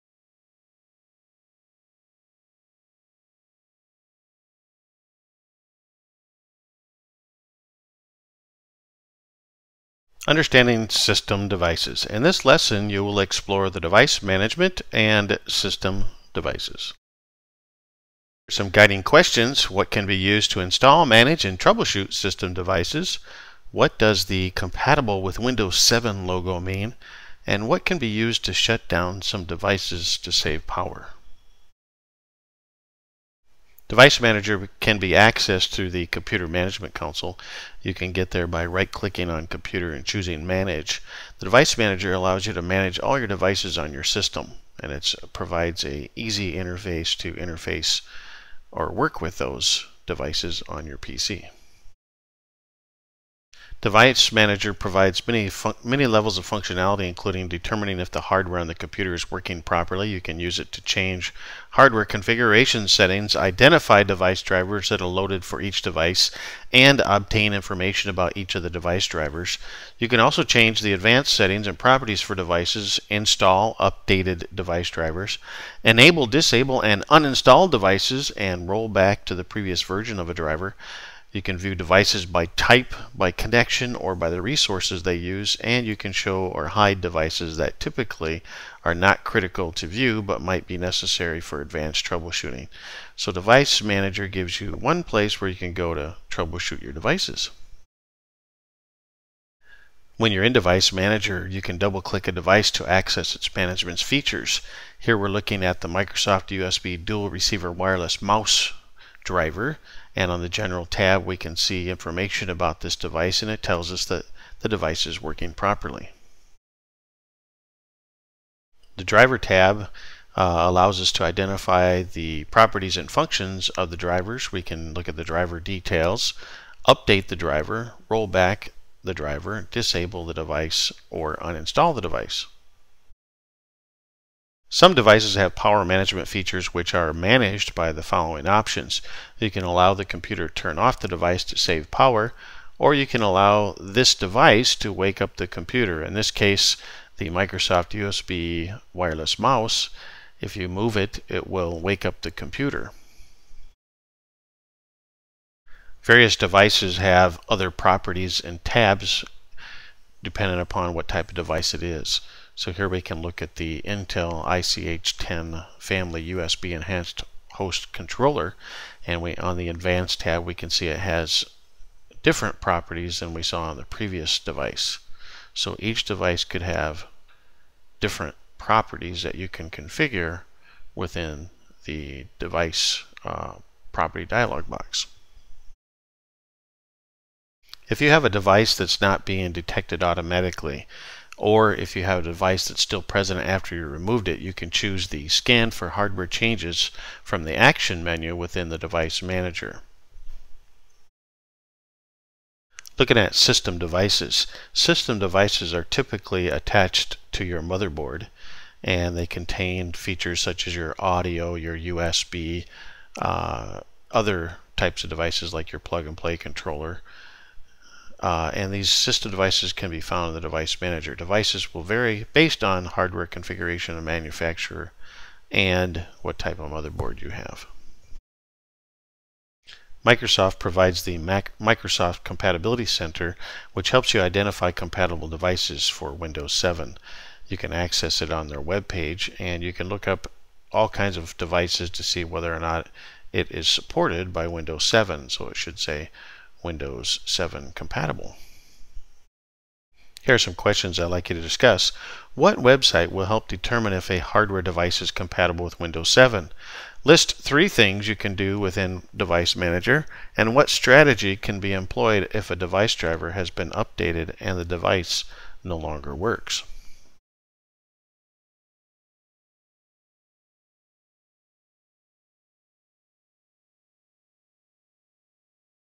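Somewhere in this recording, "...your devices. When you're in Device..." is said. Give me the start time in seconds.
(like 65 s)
96 s.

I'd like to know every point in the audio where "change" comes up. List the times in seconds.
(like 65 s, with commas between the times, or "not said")
60 s, 70 s, 196 s.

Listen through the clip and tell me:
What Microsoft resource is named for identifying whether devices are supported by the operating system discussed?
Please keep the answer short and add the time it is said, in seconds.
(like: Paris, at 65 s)
Microsoft Compatibility Center, at 231 s.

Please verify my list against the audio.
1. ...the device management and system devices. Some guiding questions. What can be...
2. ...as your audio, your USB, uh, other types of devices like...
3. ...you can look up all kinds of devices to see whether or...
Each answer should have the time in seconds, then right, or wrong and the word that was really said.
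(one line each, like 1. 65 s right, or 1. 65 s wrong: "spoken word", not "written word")
1. 13 s right
2. 210 s right
3. 239 s right.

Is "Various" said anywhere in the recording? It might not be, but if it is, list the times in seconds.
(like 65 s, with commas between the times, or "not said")
156 s.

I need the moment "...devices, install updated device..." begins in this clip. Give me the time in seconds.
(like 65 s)
72 s.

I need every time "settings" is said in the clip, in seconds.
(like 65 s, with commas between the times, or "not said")
62 s, 71 s.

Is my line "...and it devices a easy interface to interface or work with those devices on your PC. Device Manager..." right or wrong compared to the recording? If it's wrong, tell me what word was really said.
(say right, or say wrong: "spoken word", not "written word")
wrong: "provides", not "devices".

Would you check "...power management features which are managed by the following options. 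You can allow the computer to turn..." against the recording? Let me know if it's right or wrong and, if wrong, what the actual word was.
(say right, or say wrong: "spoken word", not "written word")
right.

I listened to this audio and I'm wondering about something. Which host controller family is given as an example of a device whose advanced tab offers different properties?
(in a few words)
Intel ICH10.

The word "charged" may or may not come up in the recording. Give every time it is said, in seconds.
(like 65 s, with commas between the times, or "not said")
not said.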